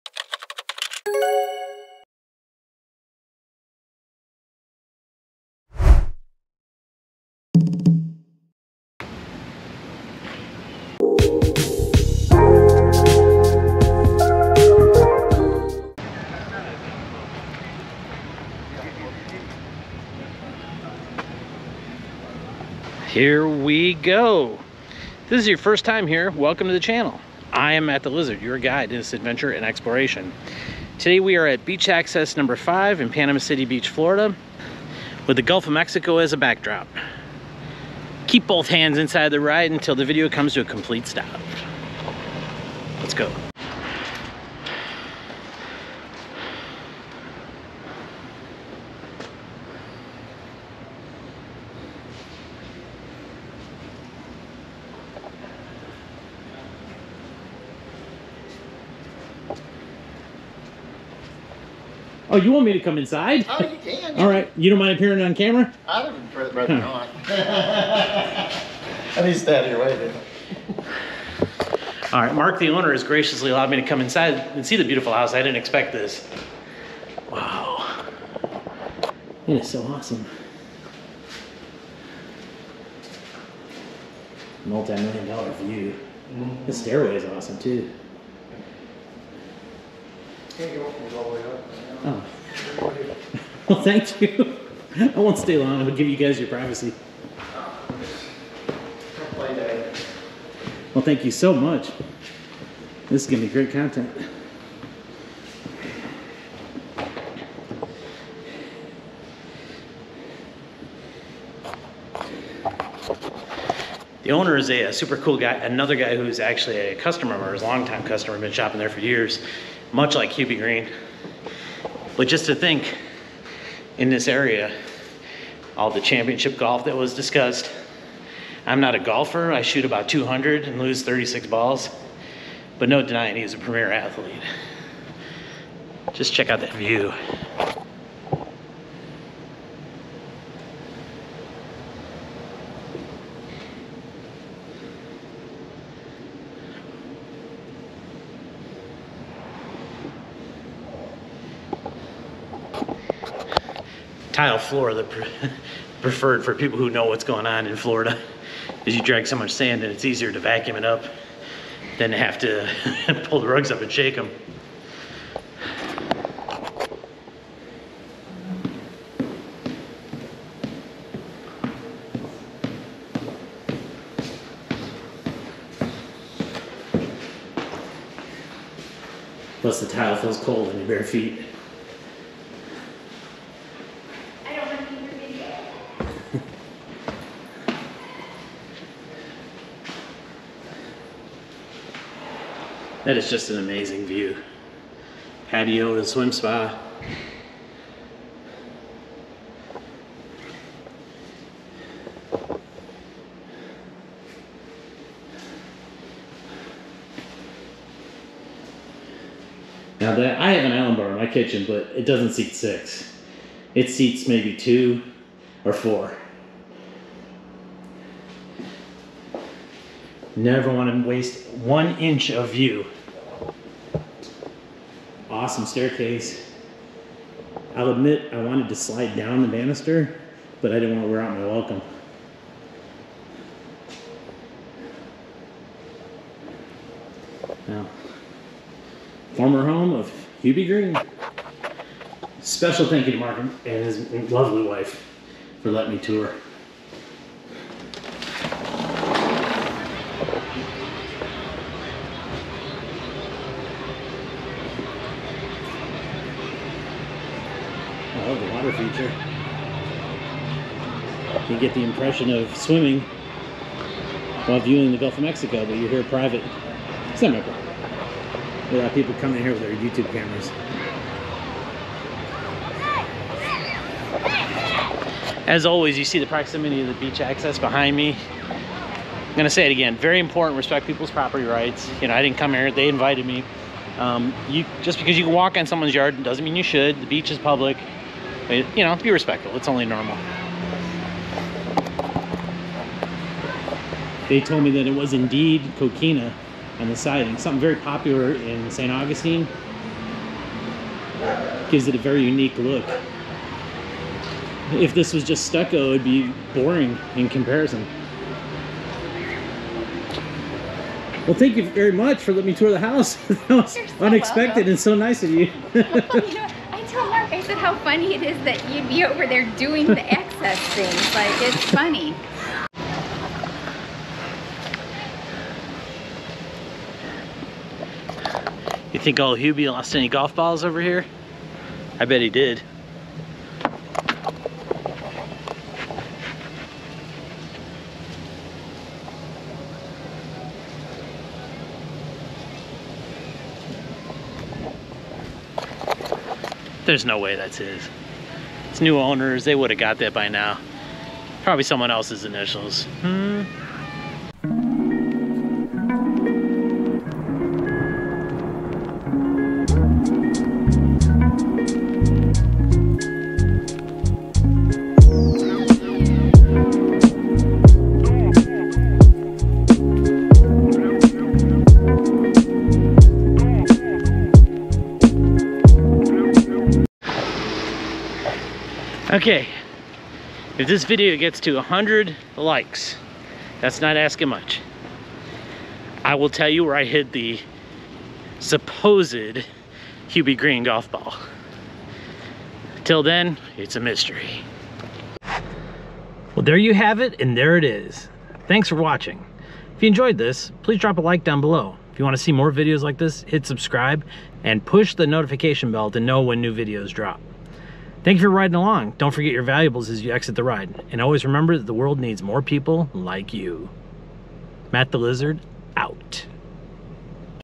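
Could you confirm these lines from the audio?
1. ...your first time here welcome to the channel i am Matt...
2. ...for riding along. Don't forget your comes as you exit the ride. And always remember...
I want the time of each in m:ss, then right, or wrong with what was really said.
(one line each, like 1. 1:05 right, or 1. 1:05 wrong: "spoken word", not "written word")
1. 0:25 right
2. 6:48 wrong: "valuables", not "comes".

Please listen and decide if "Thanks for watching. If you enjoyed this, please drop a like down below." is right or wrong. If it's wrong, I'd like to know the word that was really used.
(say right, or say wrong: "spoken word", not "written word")
right.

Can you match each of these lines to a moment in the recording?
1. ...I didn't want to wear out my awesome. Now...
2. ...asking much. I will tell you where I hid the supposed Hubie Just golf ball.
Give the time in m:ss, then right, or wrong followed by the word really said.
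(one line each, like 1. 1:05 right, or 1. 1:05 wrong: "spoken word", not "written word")
1. 3:50 wrong: "welcome", not "awesome"
2. 6:23 wrong: "Green", not "Just".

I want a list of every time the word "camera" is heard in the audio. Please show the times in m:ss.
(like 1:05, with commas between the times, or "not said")
1:05, 4:30.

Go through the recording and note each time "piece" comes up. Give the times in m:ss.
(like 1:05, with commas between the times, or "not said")
not said.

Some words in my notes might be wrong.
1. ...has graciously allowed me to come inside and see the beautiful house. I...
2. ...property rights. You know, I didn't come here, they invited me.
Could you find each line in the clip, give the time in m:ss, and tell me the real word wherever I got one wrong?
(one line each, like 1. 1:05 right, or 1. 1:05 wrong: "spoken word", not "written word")
1. 1:12 right
2. 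4:41 right.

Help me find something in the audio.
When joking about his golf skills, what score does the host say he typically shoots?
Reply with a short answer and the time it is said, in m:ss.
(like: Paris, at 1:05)
200, at 2:10.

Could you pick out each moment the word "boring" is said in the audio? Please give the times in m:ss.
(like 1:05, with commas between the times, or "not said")
5:06.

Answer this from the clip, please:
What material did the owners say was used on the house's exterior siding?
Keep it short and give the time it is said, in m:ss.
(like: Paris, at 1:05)
Coquina, at 4:55.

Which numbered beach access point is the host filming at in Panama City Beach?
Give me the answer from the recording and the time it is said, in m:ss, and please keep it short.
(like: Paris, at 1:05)
5, at 0:31.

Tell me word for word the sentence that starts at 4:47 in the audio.
The beach is public you know, be respectful.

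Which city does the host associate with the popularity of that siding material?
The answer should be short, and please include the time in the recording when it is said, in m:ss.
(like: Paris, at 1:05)
St. Augustine, at 4:58.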